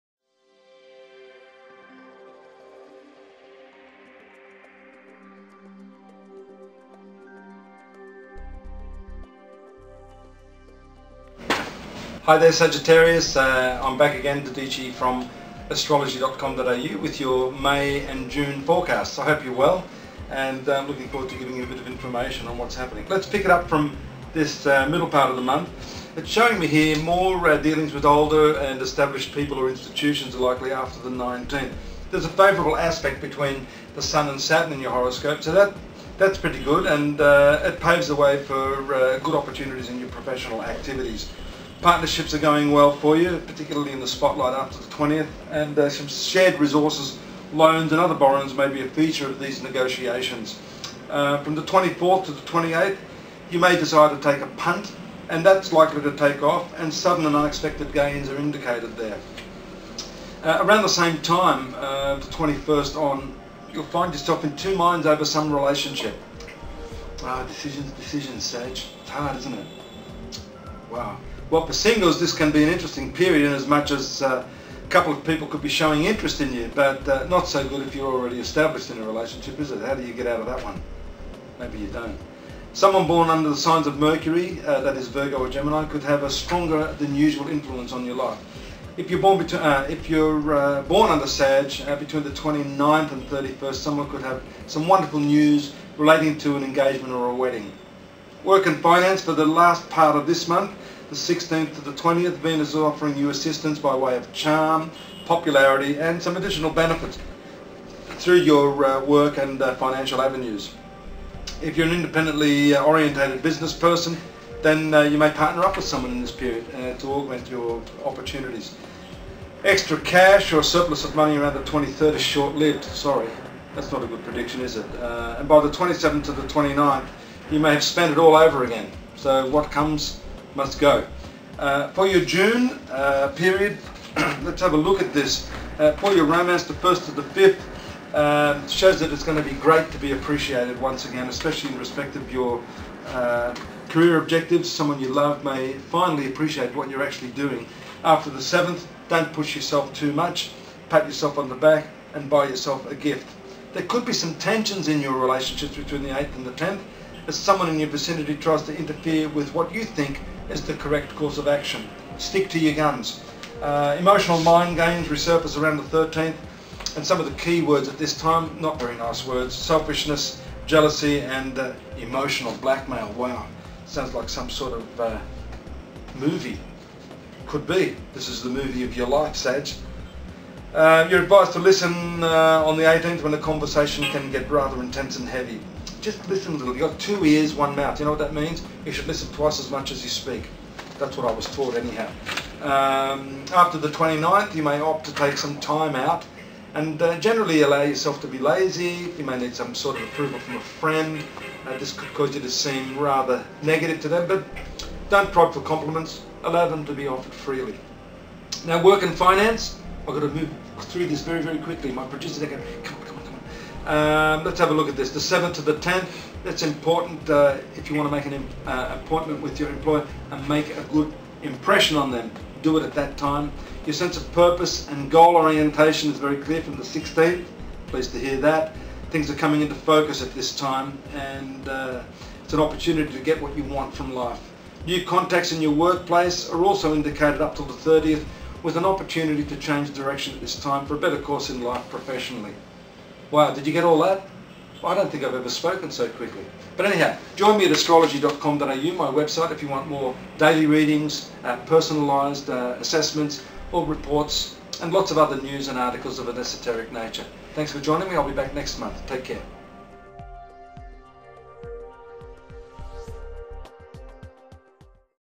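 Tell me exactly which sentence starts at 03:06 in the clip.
You've got two ears, one mouth.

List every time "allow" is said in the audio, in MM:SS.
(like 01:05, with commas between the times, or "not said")
03:17, 03:26.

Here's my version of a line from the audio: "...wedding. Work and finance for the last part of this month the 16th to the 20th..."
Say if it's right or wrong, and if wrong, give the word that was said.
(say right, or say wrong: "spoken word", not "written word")
right.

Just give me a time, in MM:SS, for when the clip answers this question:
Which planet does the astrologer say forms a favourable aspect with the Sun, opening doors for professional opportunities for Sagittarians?
00:34.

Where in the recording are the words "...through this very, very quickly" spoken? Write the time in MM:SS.
03:30.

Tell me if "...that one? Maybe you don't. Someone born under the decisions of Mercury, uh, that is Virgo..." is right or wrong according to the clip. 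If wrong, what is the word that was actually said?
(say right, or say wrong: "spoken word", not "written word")
wrong: "signs", not "decisions".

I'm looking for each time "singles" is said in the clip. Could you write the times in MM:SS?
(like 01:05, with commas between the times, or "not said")
01:11.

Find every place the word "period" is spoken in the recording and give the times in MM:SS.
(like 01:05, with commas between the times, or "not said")
01:13, 01:56, 02:13.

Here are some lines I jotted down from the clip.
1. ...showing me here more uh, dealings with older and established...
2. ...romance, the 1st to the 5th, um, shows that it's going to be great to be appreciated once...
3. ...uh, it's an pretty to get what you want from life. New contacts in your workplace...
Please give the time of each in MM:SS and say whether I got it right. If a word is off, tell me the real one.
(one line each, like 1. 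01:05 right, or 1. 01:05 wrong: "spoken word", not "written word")
1. 00:26 right
2. 02:16 right
3. 03:51 wrong: "opportunity", not "pretty".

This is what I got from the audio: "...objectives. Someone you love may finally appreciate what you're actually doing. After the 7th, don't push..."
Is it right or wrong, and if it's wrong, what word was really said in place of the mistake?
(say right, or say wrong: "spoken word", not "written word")
right.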